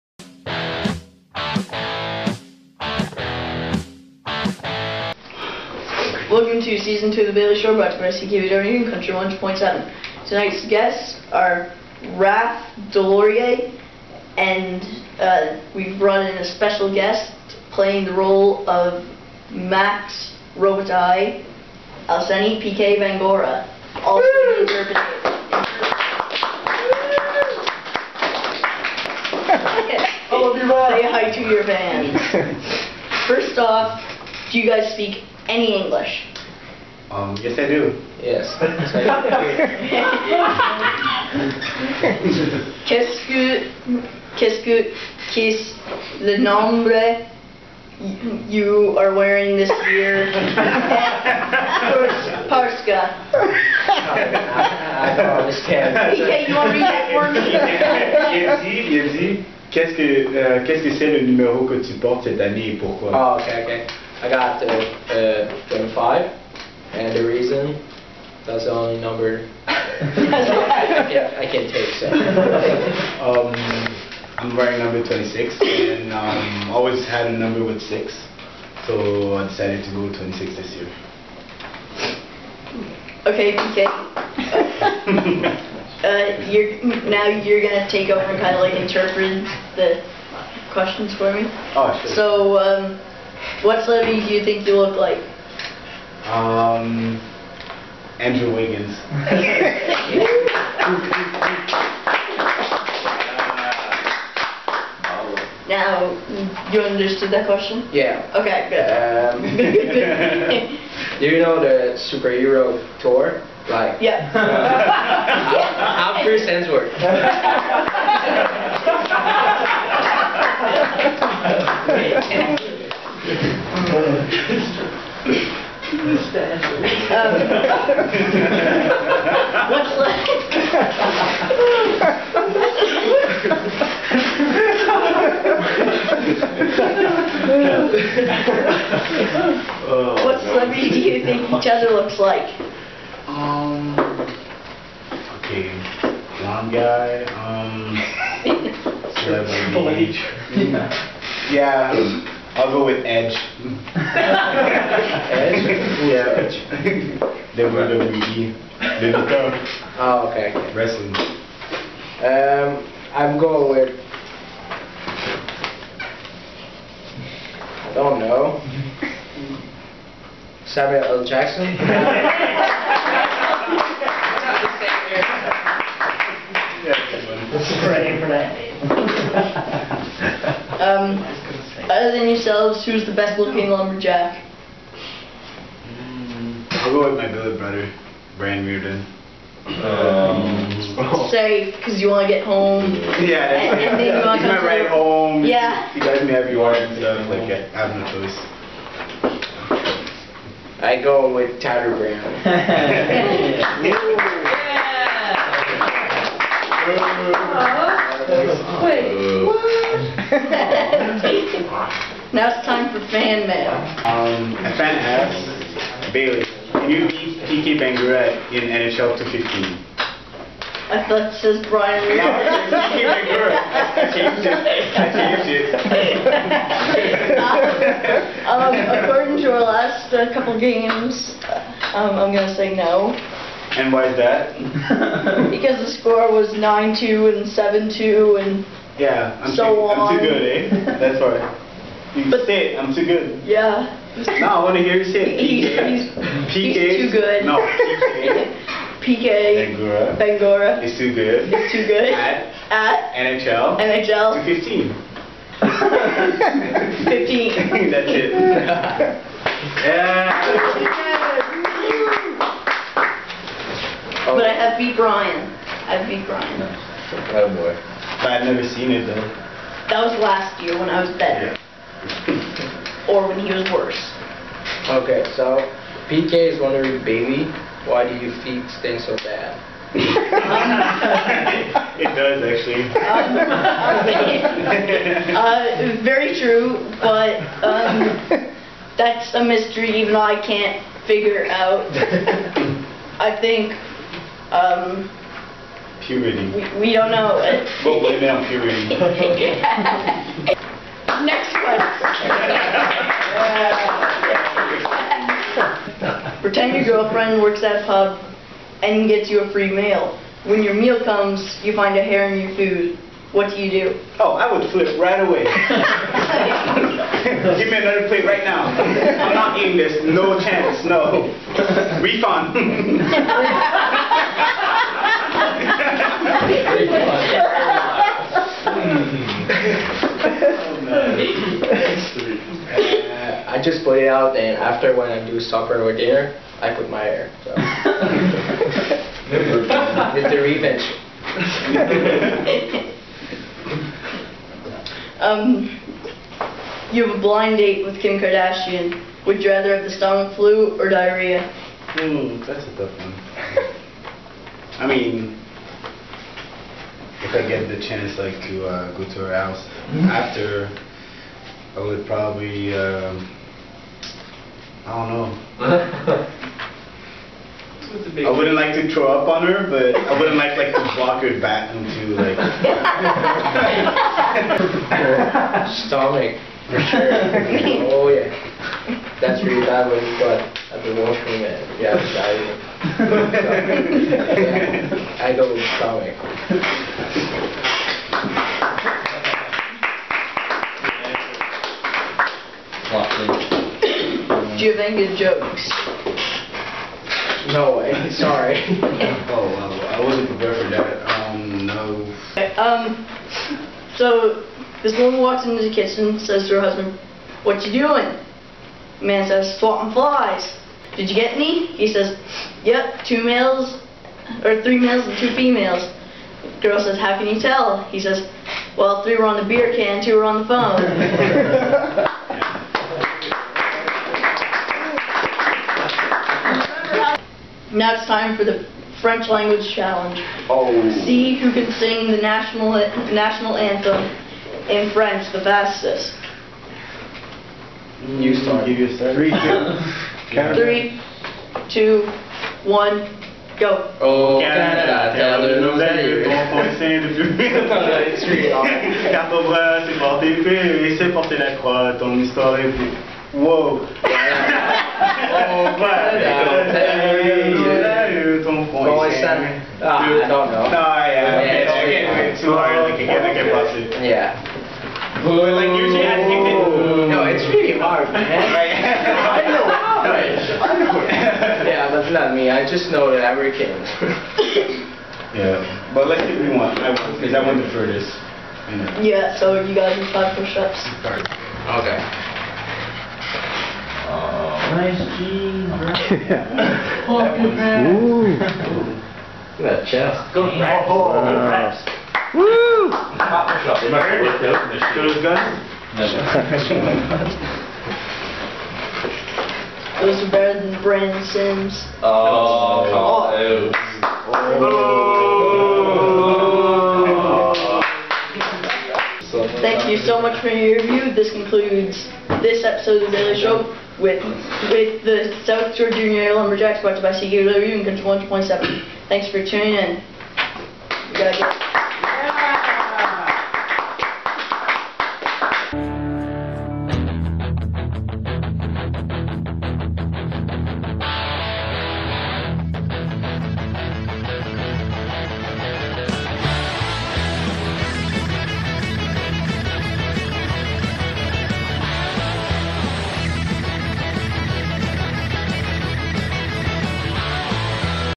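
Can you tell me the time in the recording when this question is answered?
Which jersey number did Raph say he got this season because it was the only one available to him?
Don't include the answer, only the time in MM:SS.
01:05.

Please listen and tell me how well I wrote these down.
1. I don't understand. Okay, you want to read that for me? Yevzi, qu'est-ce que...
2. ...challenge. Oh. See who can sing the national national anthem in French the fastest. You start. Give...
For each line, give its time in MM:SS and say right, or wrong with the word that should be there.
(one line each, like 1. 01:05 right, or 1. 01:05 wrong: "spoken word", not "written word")
1. 00:55 right
2. 07:09 right.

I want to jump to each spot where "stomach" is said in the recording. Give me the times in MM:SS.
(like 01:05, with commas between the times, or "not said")
05:49, 06:15, 06:25.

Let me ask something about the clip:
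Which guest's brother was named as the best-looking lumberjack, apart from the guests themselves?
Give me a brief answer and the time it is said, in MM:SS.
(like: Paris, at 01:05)
Brian Reardon, at 03:08.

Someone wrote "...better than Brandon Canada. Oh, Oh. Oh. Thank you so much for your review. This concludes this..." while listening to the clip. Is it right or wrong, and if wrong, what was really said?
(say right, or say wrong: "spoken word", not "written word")
wrong: "Sims", not "Canada".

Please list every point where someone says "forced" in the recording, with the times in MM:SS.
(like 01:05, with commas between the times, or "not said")
not said.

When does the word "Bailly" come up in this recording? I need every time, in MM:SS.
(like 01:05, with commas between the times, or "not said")
00:07, 03:36, 08:33.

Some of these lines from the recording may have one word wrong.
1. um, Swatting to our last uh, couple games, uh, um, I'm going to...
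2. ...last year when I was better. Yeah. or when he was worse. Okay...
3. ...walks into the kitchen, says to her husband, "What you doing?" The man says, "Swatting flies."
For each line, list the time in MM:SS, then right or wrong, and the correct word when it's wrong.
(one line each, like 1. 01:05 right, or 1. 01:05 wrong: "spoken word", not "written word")
1. 03:48 wrong: "according", not "Swatting"
2. 04:30 right
3. 06:45 right.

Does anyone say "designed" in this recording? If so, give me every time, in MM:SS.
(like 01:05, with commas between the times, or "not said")
not said.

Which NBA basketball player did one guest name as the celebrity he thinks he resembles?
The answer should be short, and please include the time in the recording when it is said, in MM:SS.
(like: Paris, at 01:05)
Andrew Wiggins, at 01:38.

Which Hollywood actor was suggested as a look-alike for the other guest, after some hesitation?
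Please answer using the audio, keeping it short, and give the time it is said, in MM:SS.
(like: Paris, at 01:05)
Samuel L. Jackson, at 02:50.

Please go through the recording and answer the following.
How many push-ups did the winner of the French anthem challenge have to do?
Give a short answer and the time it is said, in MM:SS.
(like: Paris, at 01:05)
5, at 08:00.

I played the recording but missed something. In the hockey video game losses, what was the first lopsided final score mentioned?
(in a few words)
9-2.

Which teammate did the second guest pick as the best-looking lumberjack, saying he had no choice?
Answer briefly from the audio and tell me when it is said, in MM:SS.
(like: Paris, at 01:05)
Tyler Brown, at 03:21.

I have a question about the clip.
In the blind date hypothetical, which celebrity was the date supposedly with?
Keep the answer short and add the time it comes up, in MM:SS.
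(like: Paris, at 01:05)
Kim Kardashian, at 05:48.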